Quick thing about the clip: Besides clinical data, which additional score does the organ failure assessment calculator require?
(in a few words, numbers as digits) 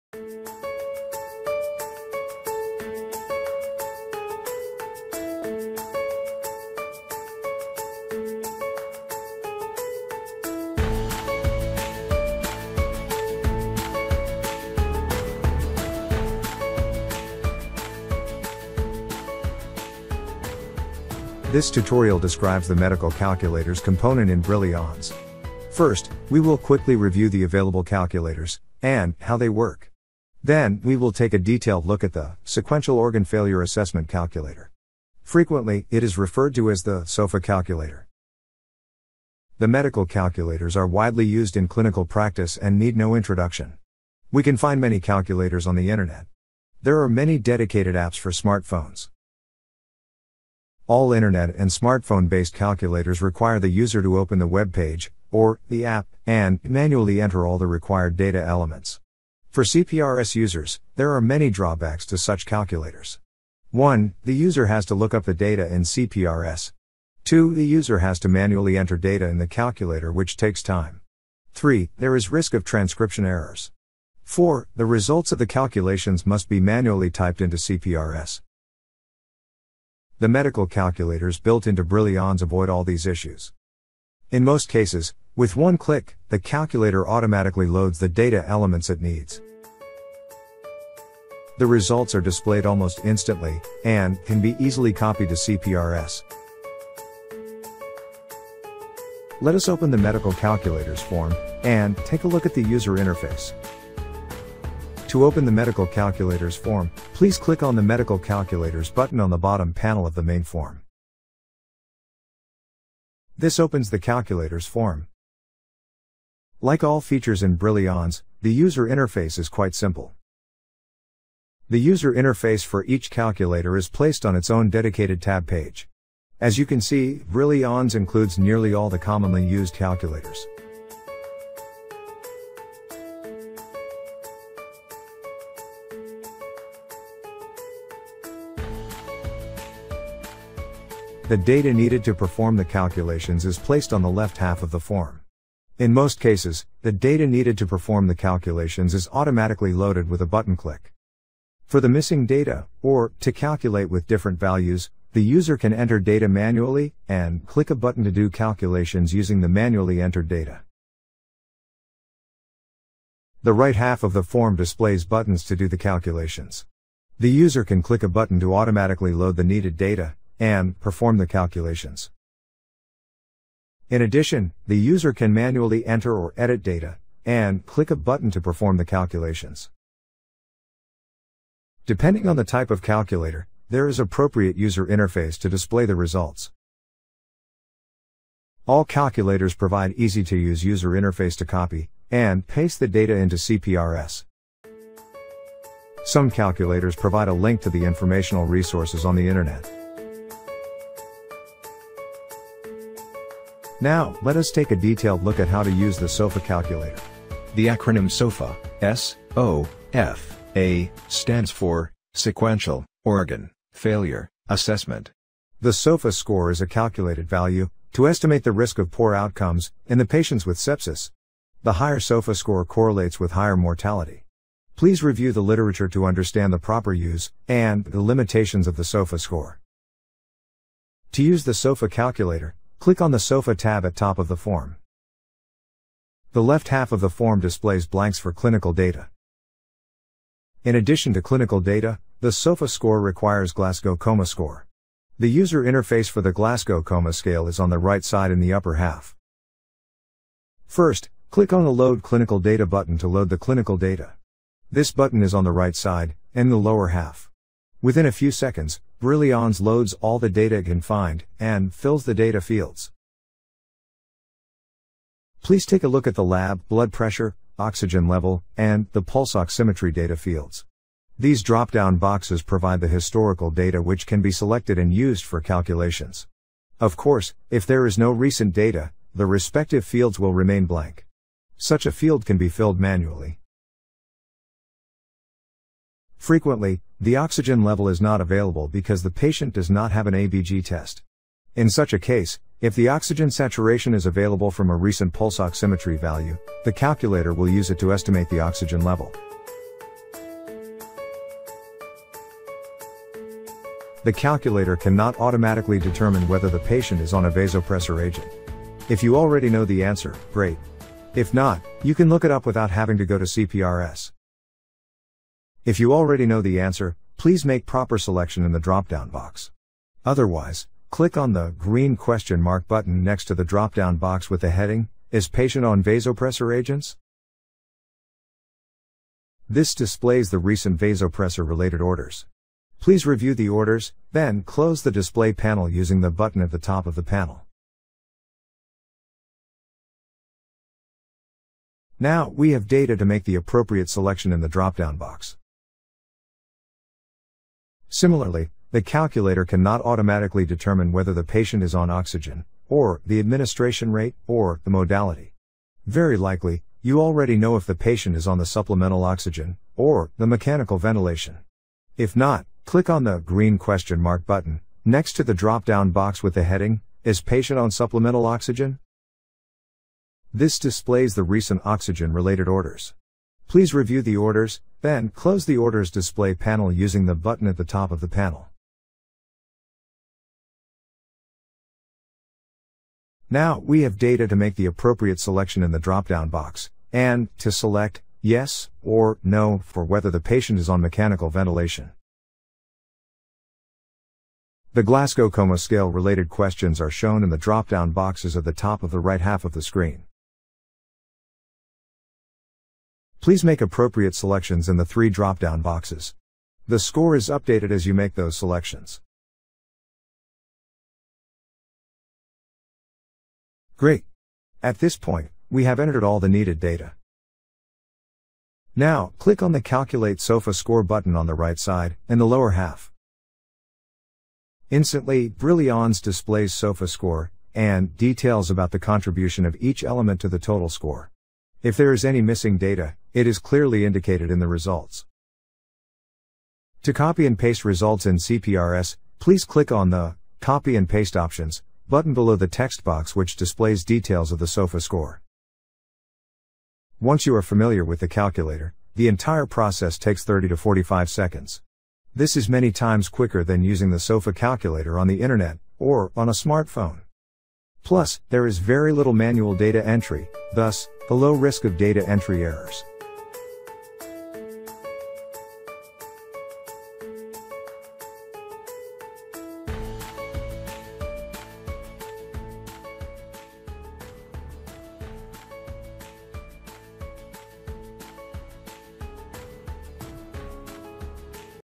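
Glasgow Coma score.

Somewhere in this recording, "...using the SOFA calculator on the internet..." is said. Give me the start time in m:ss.
7:33.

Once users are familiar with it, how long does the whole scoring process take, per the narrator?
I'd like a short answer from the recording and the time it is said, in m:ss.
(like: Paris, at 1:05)
30 to 45 seconds, at 7:30.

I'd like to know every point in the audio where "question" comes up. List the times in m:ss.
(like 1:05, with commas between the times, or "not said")
5:21, 6:03, 6:36.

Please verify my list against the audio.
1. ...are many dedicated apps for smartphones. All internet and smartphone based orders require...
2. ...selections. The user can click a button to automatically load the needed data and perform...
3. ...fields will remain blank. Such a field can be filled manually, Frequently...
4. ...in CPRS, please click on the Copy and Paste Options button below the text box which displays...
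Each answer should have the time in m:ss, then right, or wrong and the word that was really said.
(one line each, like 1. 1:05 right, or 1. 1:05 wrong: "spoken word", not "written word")
1. 0:47 wrong: "calculators", not "orders"
2. 2:45 wrong: "calculations", not "selections"
3. 4:39 right
4. 7:18 right.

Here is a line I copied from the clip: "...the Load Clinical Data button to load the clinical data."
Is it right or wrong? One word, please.
right.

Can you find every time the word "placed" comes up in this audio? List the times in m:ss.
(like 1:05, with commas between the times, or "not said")
2:03, 2:23.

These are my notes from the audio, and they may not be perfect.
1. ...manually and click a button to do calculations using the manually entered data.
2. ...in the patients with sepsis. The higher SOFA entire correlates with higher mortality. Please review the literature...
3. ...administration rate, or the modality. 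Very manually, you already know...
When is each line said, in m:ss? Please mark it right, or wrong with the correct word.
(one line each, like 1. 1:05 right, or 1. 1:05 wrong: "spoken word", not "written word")
1. 2:36 right
2. 3:39 wrong: "score", not "entire"
3. 5:53 wrong: "likely", not "manually".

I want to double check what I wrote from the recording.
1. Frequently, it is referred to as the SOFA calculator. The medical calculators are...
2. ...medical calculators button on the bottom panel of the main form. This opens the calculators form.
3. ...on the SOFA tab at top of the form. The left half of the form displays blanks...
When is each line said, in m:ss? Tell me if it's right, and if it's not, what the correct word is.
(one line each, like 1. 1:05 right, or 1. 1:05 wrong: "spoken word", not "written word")
1. 0:35 right
2. 1:47 right
3. 3:52 right.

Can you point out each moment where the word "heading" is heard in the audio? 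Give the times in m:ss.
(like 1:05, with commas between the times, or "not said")
5:24, 6:06.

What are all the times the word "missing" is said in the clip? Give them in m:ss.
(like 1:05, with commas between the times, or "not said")
2:31, 7:12.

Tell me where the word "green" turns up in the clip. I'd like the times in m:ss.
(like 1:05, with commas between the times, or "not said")
5:21, 6:03.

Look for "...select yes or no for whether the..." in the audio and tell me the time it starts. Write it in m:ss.
6:27.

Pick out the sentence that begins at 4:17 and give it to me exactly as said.
Within a few seconds, Brillians loads all the data it can find, and fills the data fields.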